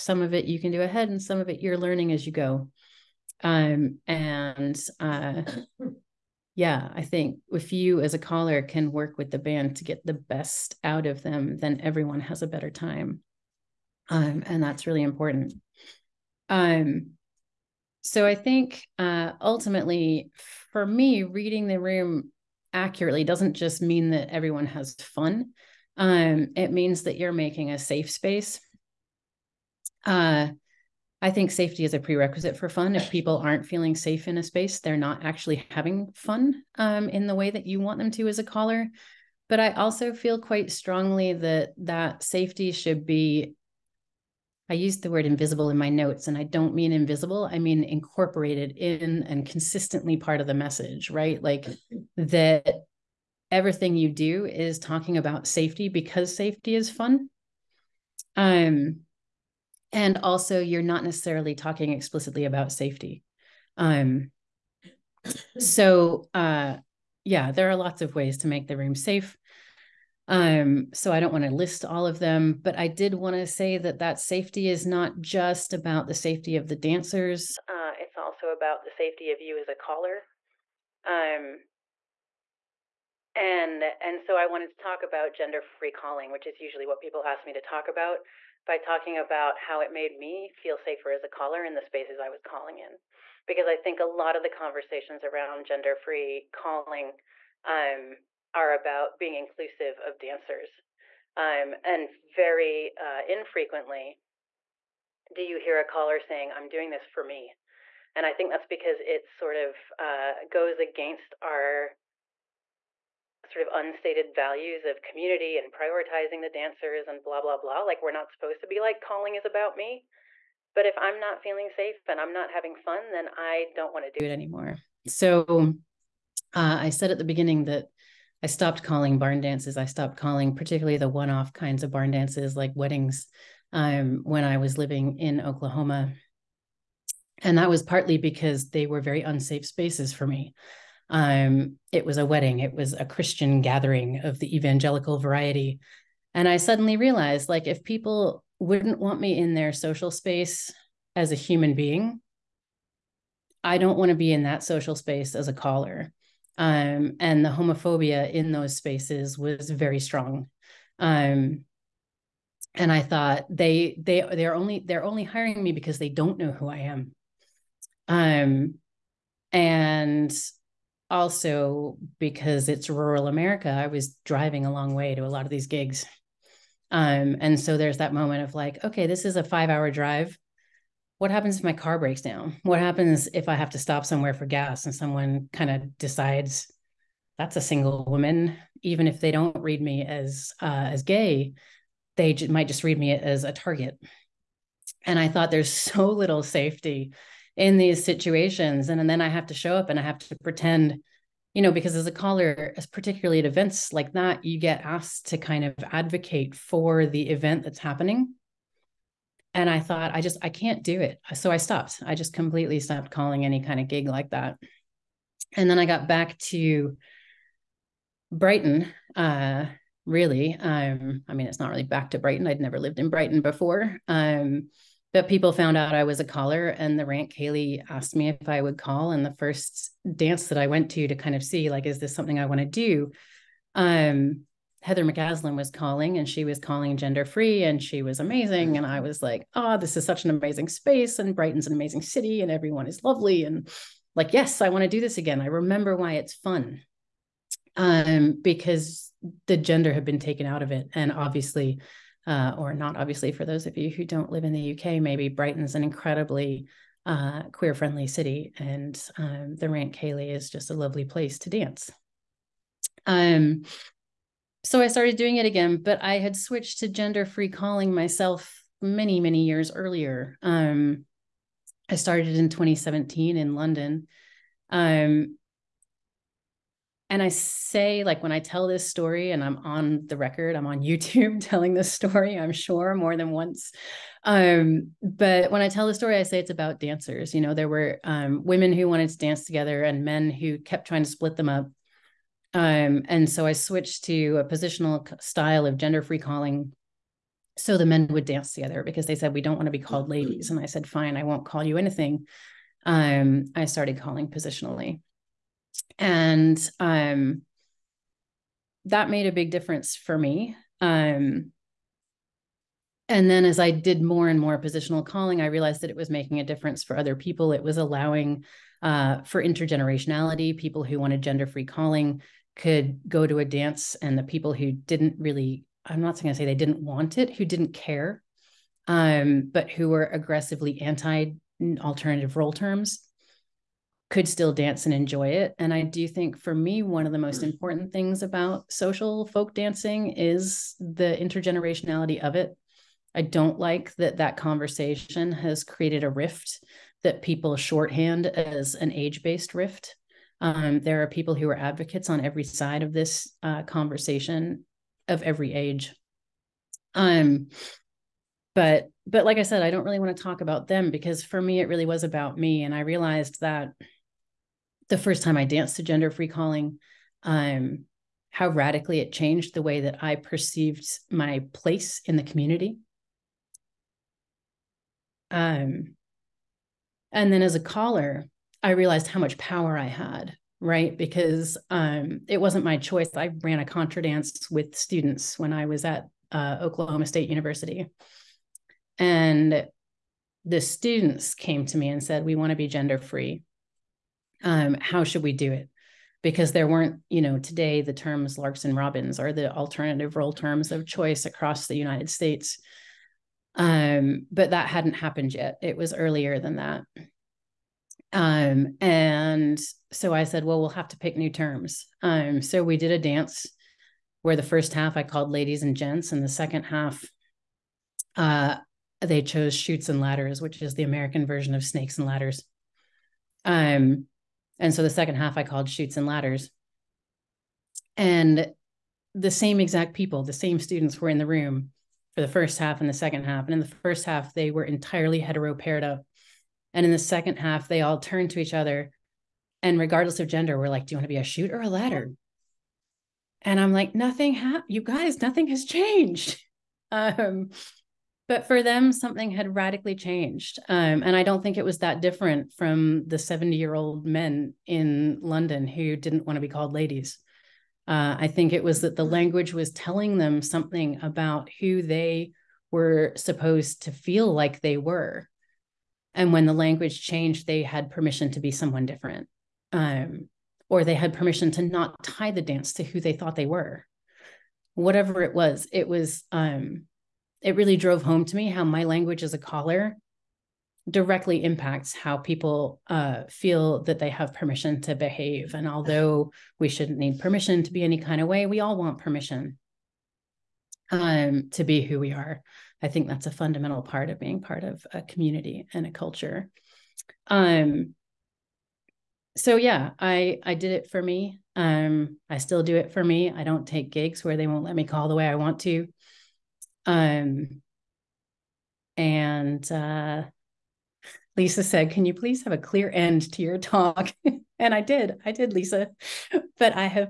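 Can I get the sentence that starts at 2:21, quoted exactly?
Um, it was a wedding, it was a Christian gathering of the evangelical variety.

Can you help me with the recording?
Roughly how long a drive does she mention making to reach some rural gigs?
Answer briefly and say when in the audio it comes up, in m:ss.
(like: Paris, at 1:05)
5 hours, at 2:59.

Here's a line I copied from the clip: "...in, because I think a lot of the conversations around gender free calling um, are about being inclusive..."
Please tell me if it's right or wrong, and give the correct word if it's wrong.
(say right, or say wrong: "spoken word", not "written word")
right.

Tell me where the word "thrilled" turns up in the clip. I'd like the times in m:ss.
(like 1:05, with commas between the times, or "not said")
not said.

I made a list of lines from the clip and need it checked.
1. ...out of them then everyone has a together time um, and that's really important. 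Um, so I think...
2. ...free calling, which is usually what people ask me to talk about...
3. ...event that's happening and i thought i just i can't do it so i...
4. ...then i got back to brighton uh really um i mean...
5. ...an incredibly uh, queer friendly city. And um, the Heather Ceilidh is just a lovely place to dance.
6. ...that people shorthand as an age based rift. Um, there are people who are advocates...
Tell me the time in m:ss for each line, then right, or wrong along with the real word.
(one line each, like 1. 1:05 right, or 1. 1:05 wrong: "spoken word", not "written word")
1. 0:10 wrong: "better", not "together"
2. 1:25 right
3. 3:27 right
4. 3:35 right
5. 4:15 wrong: "Rant", not "Heather"
6. 5:47 right.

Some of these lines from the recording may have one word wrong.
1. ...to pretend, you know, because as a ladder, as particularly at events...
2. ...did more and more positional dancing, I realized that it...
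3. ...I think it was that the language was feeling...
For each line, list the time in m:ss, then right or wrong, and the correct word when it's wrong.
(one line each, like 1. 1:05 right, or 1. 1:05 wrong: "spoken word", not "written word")
1. 3:20 wrong: "caller", not "ladder"
2. 5:13 wrong: "calling", not "dancing"
3. 7:38 wrong: "telling", not "feeling".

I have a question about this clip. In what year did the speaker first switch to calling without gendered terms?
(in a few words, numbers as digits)
2017.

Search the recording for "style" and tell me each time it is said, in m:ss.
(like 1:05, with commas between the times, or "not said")
4:55.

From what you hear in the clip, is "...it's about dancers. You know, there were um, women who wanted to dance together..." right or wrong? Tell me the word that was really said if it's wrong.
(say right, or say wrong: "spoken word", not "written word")
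right.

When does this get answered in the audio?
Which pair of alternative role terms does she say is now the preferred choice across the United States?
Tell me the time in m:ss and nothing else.
6:38.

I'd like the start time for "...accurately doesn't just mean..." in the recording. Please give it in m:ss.
0:22.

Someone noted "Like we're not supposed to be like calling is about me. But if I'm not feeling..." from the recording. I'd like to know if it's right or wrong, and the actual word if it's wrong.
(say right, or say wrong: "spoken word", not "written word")
right.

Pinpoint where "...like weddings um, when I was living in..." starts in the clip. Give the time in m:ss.
2:12.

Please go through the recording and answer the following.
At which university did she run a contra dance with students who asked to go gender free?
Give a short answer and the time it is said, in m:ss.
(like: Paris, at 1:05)
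Oklahoma State University, at 6:26.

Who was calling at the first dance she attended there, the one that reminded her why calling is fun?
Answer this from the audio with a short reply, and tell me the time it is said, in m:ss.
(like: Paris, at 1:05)
Heather McCaslin, at 3:54.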